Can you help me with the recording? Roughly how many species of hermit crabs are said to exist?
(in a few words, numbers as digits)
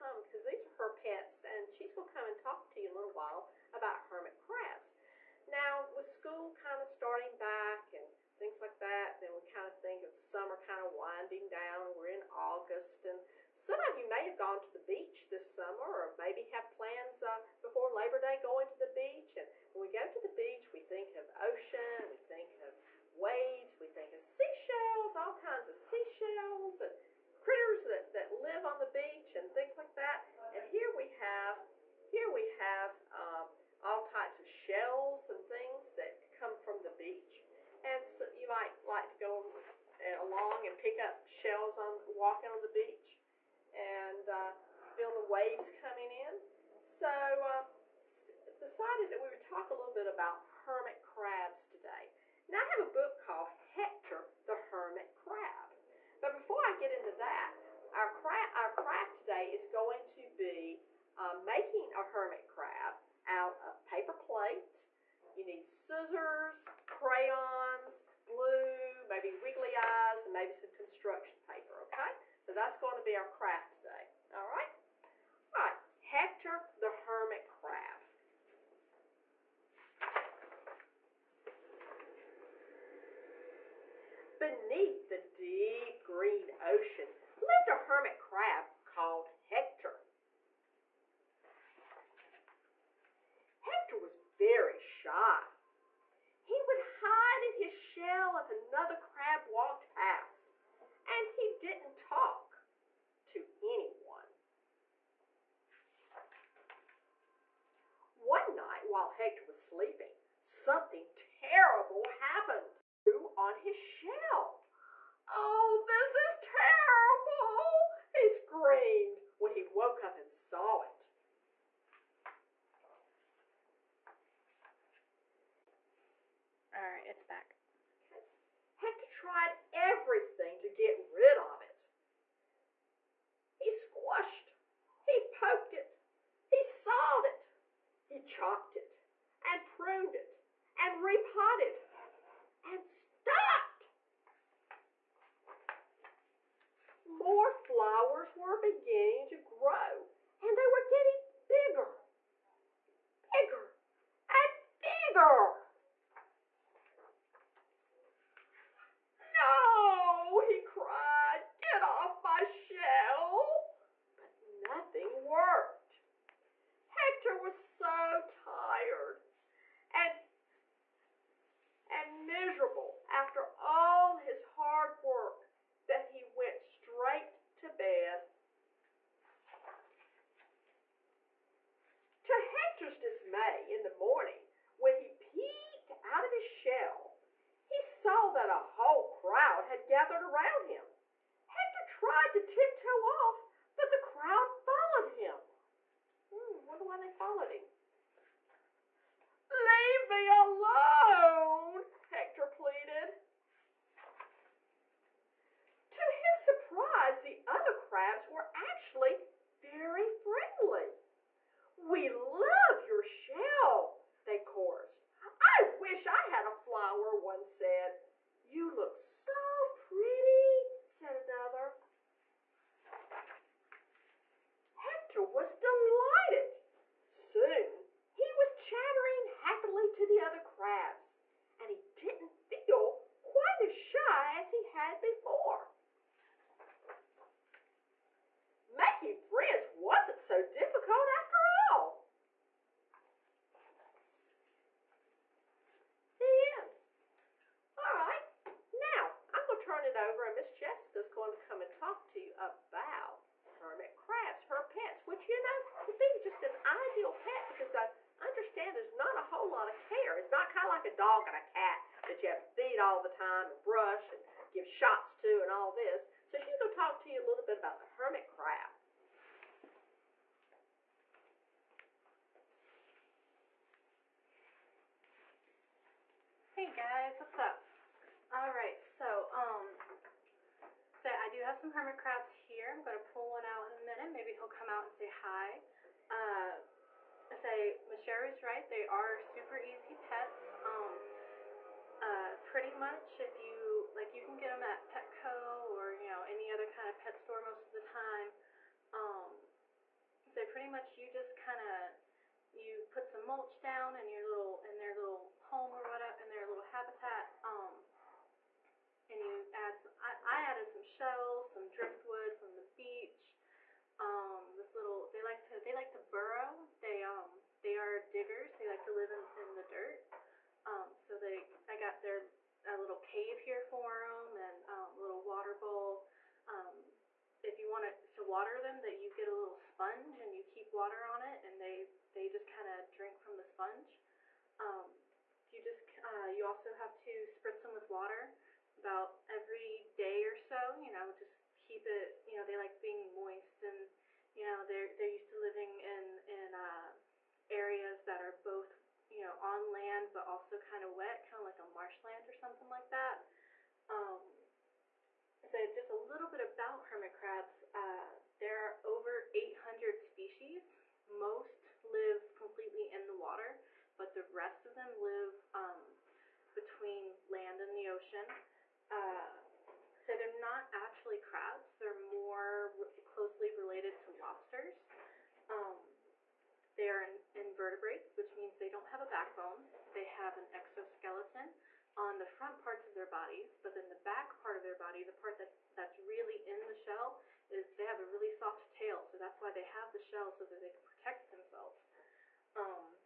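over 800.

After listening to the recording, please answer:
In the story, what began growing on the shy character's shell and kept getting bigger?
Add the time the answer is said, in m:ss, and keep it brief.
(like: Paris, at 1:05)
flowers, at 2:27.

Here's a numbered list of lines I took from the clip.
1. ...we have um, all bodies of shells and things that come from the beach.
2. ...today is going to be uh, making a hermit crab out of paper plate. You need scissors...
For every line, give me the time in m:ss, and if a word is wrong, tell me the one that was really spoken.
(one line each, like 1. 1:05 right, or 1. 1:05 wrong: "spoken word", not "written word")
1. 0:32 wrong: "types", not "bodies"
2. 0:59 right.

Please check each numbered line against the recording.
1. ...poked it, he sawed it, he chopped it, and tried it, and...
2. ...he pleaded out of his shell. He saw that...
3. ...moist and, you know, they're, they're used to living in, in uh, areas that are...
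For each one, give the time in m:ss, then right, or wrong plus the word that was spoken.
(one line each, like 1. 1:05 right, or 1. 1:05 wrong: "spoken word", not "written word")
1. 2:15 wrong: "pruned", not "tried"
2. 3:04 wrong: "peeked", not "pleaded"
3. 5:43 right.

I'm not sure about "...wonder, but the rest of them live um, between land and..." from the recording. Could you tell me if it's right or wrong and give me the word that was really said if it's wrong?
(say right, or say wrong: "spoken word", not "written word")
wrong: "water", not "wonder".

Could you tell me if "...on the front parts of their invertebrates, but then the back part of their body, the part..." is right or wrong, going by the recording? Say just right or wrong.
wrong.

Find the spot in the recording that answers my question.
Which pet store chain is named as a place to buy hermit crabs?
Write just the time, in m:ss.
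4:54.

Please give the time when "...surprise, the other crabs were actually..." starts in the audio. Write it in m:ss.
3:26.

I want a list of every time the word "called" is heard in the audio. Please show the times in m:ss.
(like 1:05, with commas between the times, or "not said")
0:53, 1:28.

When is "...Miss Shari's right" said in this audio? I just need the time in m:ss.
4:47.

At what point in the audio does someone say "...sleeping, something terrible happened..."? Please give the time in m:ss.
1:49.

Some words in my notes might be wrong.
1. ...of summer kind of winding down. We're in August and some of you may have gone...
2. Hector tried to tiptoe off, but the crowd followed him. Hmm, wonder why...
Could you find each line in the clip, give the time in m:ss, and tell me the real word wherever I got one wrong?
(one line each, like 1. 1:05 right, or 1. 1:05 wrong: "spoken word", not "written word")
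1. 0:10 right
2. 3:11 right.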